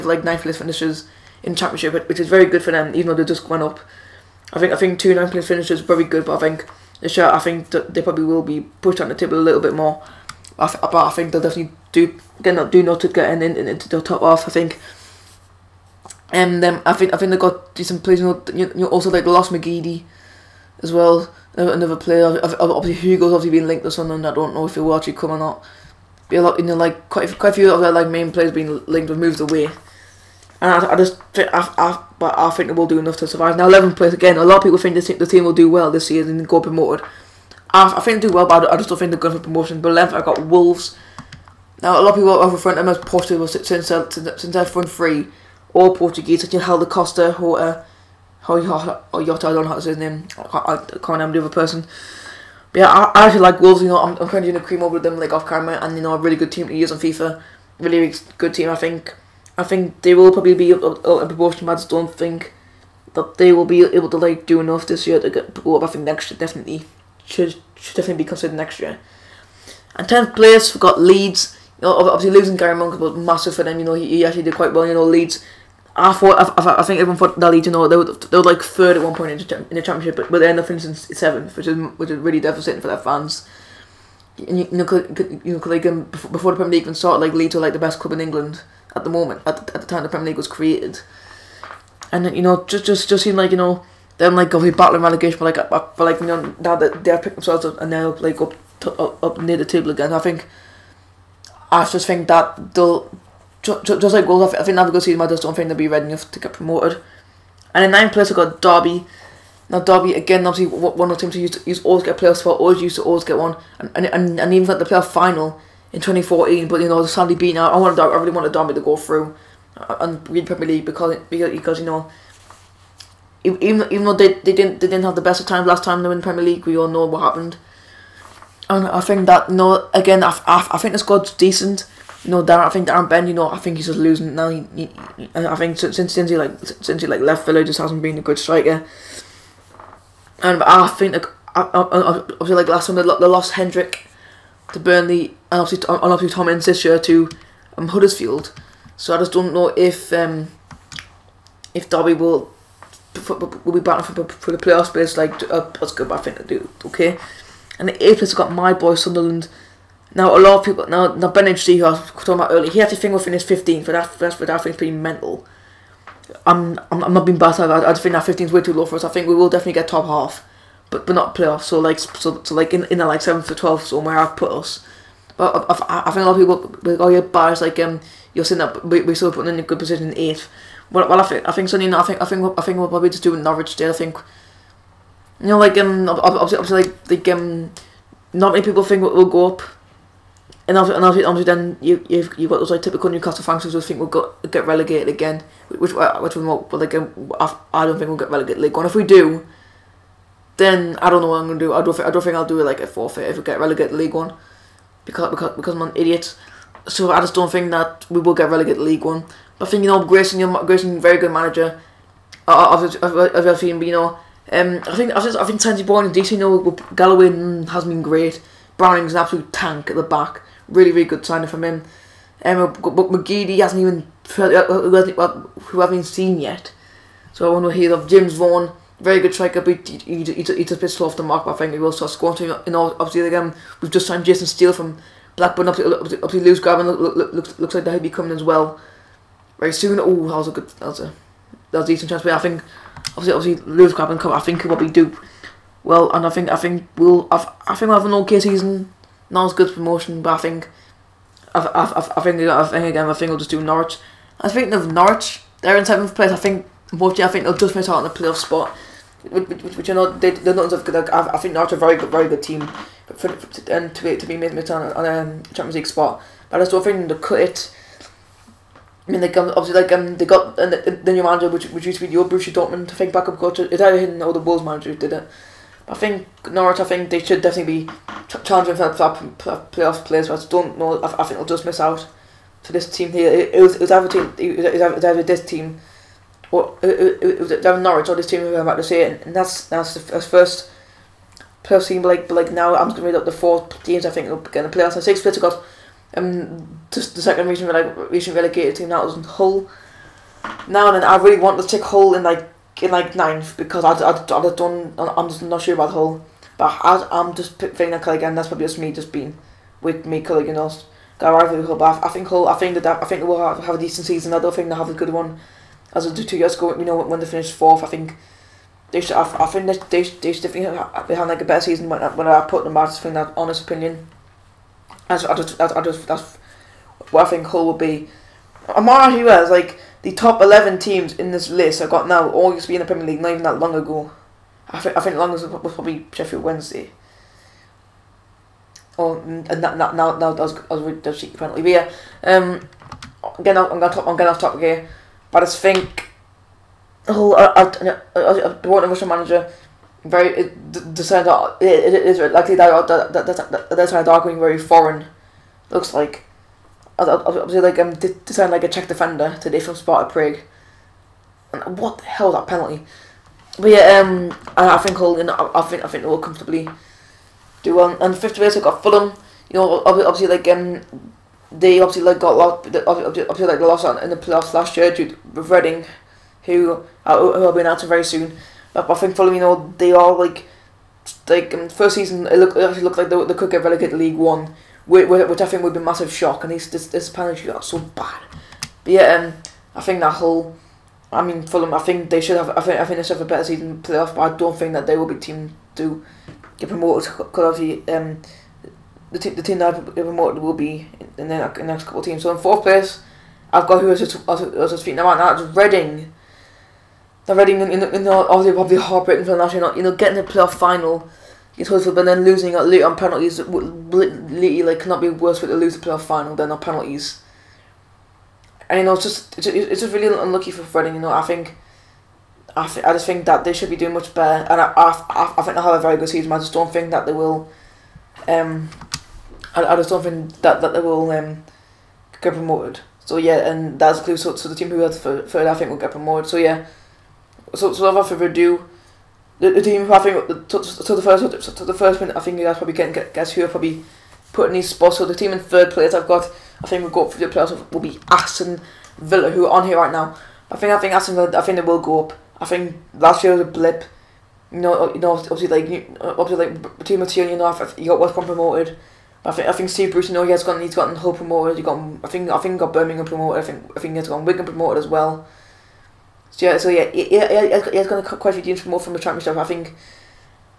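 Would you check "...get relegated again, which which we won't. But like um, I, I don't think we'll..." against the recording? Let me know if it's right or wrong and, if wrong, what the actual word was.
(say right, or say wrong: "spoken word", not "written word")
right.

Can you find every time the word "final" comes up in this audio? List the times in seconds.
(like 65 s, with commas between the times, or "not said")
115 s, 410 s, 416 s.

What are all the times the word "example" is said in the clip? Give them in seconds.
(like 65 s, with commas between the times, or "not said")
not said.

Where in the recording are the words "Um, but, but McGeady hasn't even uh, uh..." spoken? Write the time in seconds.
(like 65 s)
222 s.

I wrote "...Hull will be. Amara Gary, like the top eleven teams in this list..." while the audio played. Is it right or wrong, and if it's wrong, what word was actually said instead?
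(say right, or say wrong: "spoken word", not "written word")
wrong: "Huez", not "Gary".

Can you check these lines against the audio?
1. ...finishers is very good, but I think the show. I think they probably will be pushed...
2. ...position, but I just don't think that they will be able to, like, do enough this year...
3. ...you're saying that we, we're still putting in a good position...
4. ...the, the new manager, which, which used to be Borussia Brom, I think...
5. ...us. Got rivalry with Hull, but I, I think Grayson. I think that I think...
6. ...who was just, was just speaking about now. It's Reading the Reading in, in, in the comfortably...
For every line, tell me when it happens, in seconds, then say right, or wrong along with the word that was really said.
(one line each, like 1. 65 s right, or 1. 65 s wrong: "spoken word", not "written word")
1. 5 s right
2. 61 s wrong: "proportion", not "position"
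3. 178 s right
4. 270 s wrong: "Dortmund", not "Brom"
5. 310 s wrong: "Hull", not "Grayson"
6. 403 s wrong: "obviously", not "comfortably".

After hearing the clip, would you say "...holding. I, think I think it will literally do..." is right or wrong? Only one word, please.
wrong.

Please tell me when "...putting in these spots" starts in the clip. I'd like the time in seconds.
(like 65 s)
444 s.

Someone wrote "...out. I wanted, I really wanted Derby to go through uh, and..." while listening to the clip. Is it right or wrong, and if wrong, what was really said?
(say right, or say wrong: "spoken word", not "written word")
right.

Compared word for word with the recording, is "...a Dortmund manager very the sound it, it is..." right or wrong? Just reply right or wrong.
wrong.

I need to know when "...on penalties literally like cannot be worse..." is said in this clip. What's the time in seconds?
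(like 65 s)
412 s.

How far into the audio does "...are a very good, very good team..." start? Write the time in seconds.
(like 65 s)
261 s.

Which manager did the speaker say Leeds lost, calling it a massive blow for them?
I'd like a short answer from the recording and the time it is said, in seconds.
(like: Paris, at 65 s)
Gary Monk, at 72 s.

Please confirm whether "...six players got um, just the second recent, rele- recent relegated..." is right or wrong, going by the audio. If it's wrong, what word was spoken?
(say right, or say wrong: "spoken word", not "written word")
right.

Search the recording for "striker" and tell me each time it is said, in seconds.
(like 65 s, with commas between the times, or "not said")
138 s, 229 s.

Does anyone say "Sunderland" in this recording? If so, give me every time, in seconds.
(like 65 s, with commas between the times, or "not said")
158 s.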